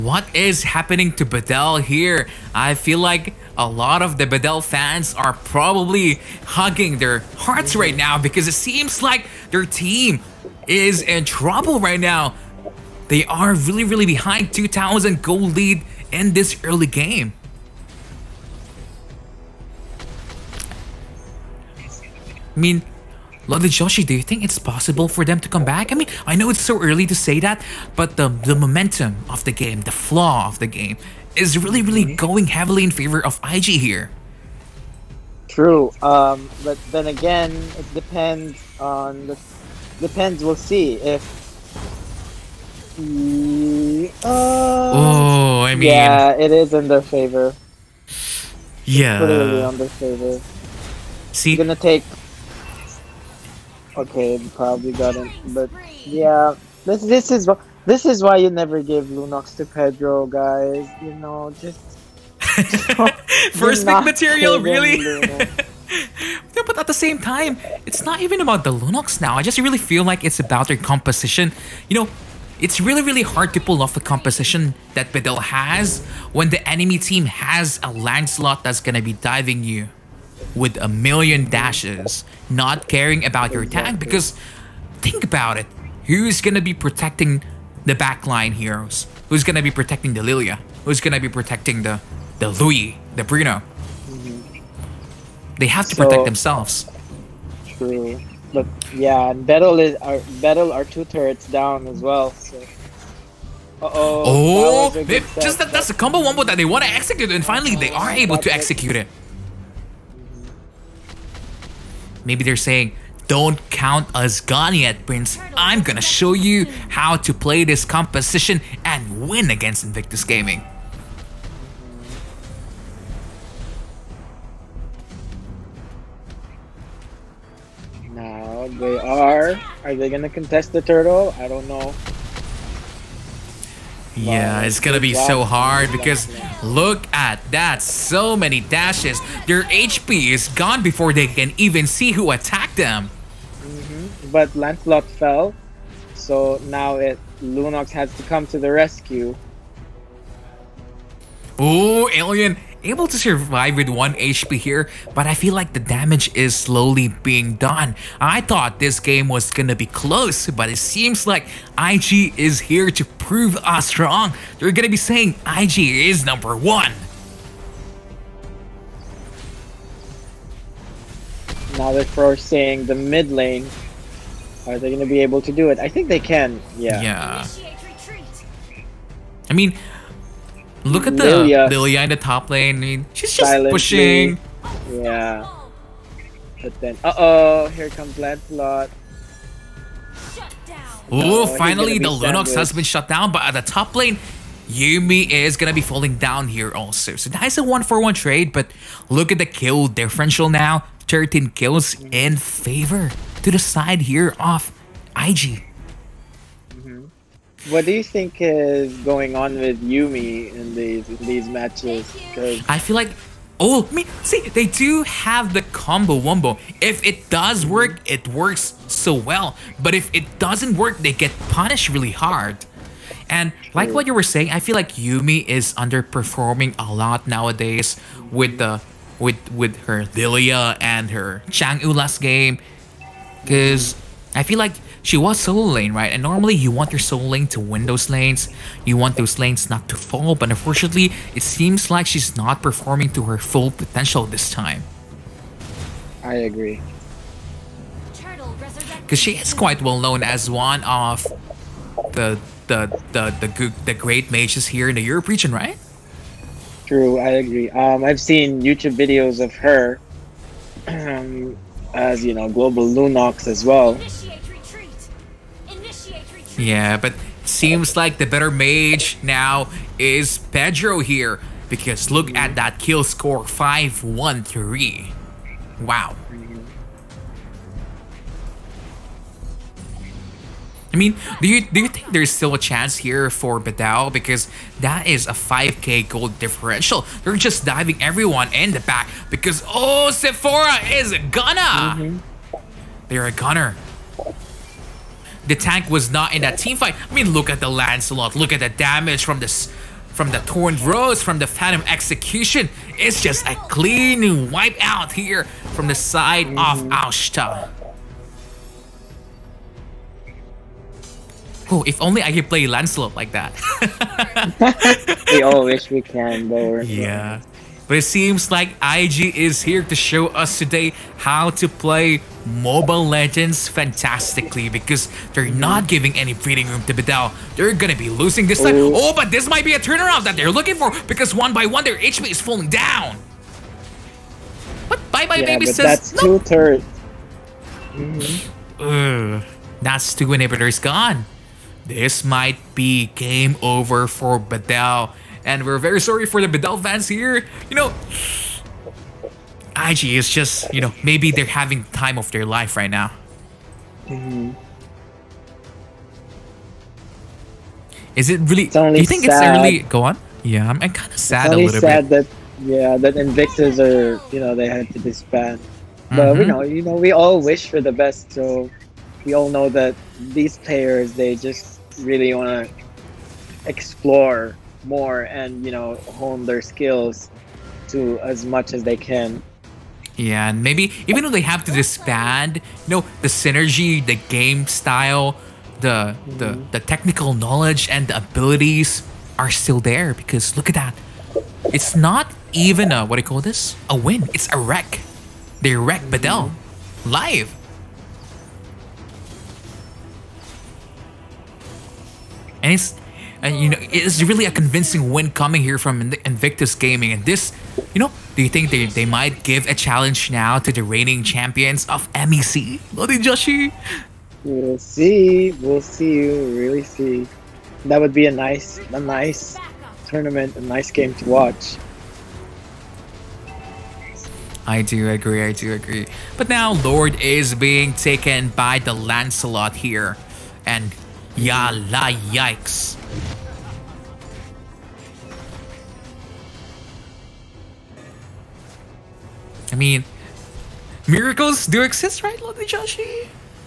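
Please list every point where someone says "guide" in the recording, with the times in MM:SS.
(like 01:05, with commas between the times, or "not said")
not said.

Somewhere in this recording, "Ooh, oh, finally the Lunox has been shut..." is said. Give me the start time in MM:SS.
03:11.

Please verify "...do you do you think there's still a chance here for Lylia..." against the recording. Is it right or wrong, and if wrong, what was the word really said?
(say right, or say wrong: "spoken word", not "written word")
wrong: "Bedel", not "Lylia".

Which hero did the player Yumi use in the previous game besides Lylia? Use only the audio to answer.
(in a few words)
Chang'e.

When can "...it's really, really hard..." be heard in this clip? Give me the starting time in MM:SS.
01:12.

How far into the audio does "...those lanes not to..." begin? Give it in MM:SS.
03:59.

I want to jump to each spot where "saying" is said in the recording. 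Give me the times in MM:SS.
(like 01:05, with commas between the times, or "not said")
01:52, 02:44, 03:44.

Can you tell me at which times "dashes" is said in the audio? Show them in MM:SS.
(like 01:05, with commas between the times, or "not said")
01:21, 02:18.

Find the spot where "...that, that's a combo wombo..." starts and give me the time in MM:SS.
01:45.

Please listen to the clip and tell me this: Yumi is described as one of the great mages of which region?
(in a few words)
Europe.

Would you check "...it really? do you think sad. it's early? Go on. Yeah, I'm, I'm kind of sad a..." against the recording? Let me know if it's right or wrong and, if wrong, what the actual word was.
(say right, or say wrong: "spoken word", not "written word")
right.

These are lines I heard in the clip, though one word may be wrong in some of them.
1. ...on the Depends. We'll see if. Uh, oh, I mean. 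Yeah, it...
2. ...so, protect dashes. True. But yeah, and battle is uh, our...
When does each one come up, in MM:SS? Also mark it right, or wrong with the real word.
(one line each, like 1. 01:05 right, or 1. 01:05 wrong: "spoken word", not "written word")
1. 00:38 right
2. 01:35 wrong: "themselves", not "dashes".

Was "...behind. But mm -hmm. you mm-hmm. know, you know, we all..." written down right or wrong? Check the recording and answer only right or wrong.
wrong.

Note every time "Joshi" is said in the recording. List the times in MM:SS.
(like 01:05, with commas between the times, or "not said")
00:23, 06:53, 07:22.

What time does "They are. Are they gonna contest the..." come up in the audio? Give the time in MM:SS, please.
02:08.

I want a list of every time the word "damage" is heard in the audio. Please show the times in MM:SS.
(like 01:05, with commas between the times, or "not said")
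02:35, 04:58.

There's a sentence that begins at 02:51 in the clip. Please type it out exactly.
Now they're first the mid lane.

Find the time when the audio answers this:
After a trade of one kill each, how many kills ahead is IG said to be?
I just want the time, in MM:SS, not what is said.
03:21.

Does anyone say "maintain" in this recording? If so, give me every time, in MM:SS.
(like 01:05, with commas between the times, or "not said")
not said.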